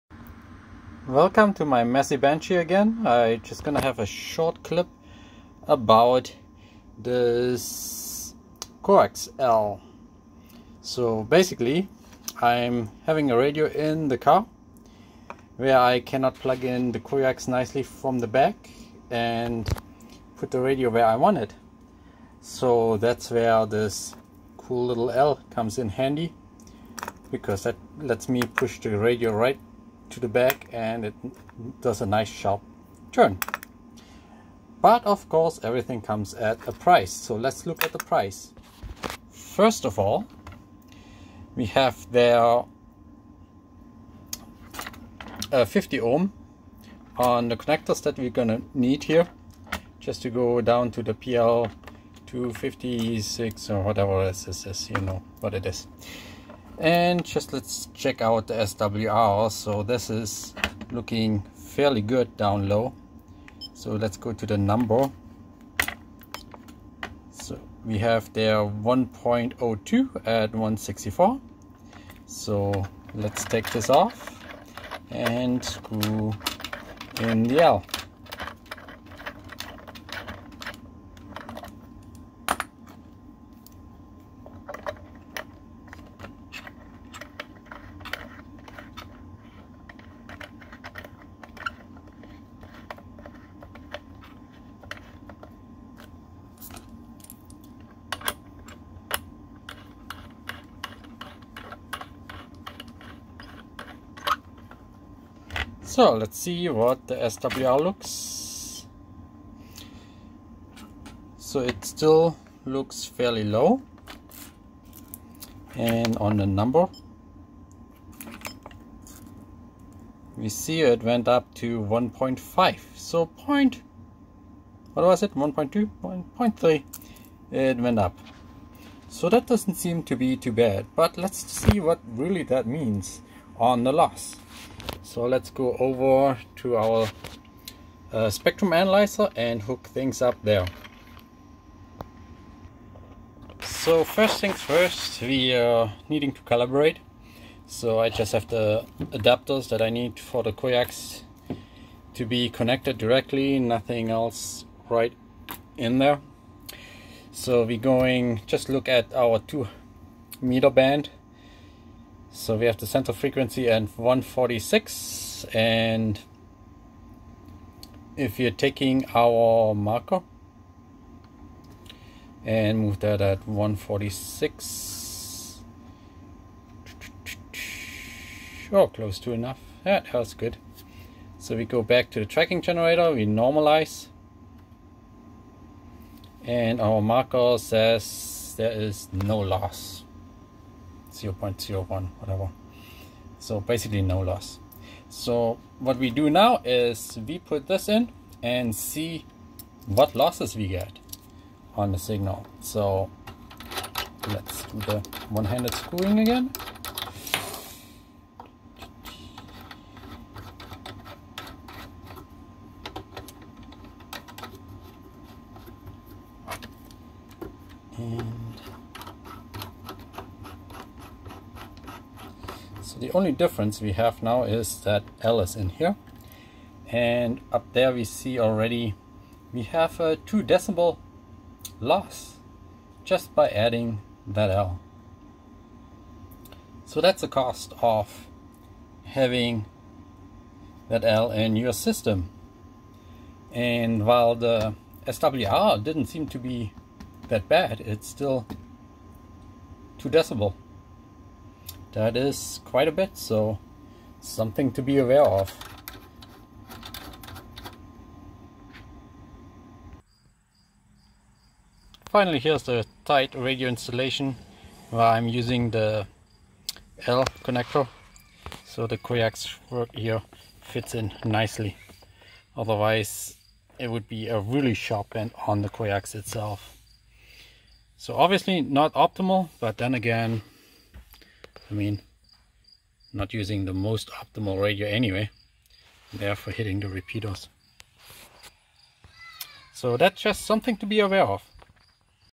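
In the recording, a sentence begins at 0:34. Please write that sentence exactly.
But of course everything comes at a price.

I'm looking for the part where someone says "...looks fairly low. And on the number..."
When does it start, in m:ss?
1:52.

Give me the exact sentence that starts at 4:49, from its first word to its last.
So that's just something to be aware of.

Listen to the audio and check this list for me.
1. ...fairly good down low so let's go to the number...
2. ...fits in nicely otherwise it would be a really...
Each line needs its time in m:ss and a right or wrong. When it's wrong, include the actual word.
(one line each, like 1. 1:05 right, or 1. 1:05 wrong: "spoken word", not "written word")
1. 1:01 right
2. 4:30 right.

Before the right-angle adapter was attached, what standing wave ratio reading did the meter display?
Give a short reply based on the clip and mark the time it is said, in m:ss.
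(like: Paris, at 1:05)
1.02, at 1:08.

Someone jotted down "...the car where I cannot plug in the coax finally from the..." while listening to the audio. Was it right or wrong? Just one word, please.
wrong.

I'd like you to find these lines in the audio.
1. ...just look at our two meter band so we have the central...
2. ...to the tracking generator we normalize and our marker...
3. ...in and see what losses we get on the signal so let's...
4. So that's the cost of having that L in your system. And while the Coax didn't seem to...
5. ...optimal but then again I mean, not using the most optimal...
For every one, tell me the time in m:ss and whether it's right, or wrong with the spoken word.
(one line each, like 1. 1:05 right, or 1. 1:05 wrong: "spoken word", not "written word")
1. 2:38 right
2. 3:02 right
3. 3:17 right
4. 3:56 wrong: "SWR", not "Coax"
5. 4:38 right.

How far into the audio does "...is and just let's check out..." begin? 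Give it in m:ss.
0:55.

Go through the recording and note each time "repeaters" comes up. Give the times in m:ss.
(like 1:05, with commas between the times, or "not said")
4:46.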